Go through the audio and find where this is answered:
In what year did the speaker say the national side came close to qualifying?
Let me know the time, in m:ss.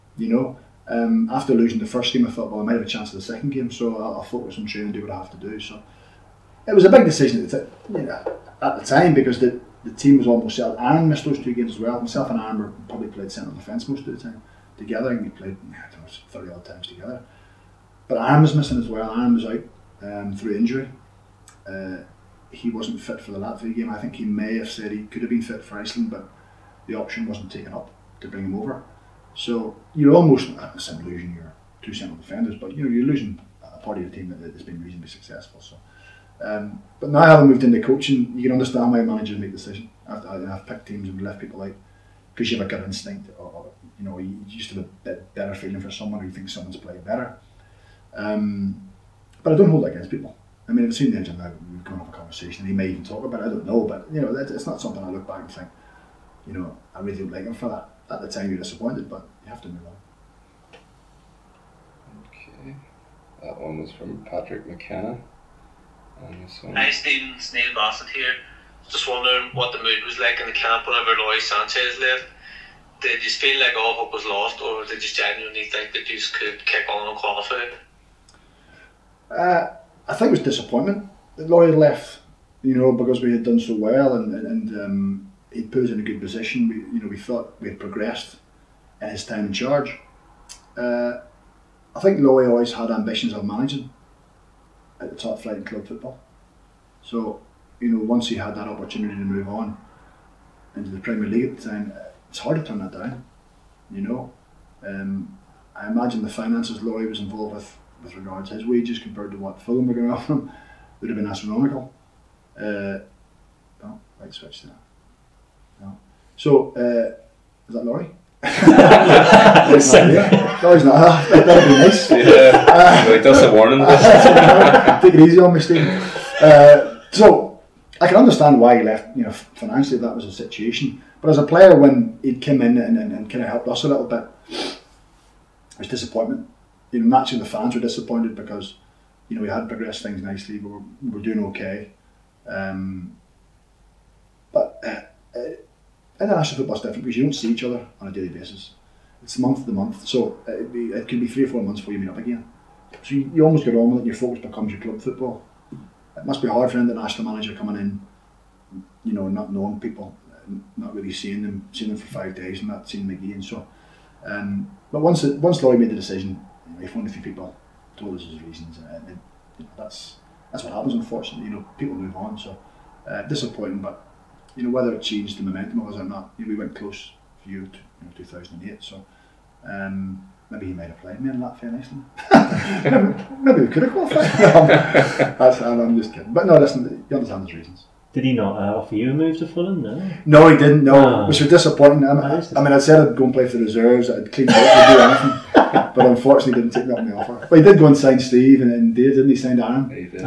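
2:58.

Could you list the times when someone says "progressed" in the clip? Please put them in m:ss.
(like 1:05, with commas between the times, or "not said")
1:27, 2:19.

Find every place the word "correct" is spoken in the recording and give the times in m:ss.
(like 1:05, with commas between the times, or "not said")
not said.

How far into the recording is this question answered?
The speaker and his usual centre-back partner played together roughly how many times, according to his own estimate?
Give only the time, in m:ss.
0:16.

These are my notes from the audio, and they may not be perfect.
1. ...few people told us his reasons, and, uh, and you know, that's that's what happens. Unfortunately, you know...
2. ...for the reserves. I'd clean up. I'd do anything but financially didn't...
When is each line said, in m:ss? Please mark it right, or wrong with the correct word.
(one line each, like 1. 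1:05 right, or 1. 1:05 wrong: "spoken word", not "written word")
1. 2:47 right
2. 3:13 wrong: "unfortunately", not "financially".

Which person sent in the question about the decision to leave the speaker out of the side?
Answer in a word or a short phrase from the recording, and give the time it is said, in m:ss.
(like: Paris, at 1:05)
Patrick McKenna, at 1:04.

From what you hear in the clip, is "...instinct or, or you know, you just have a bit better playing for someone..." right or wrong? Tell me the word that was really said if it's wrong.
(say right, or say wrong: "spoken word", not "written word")
wrong: "feeling", not "playing".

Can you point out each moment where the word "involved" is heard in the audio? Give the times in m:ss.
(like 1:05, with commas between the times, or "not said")
1:47.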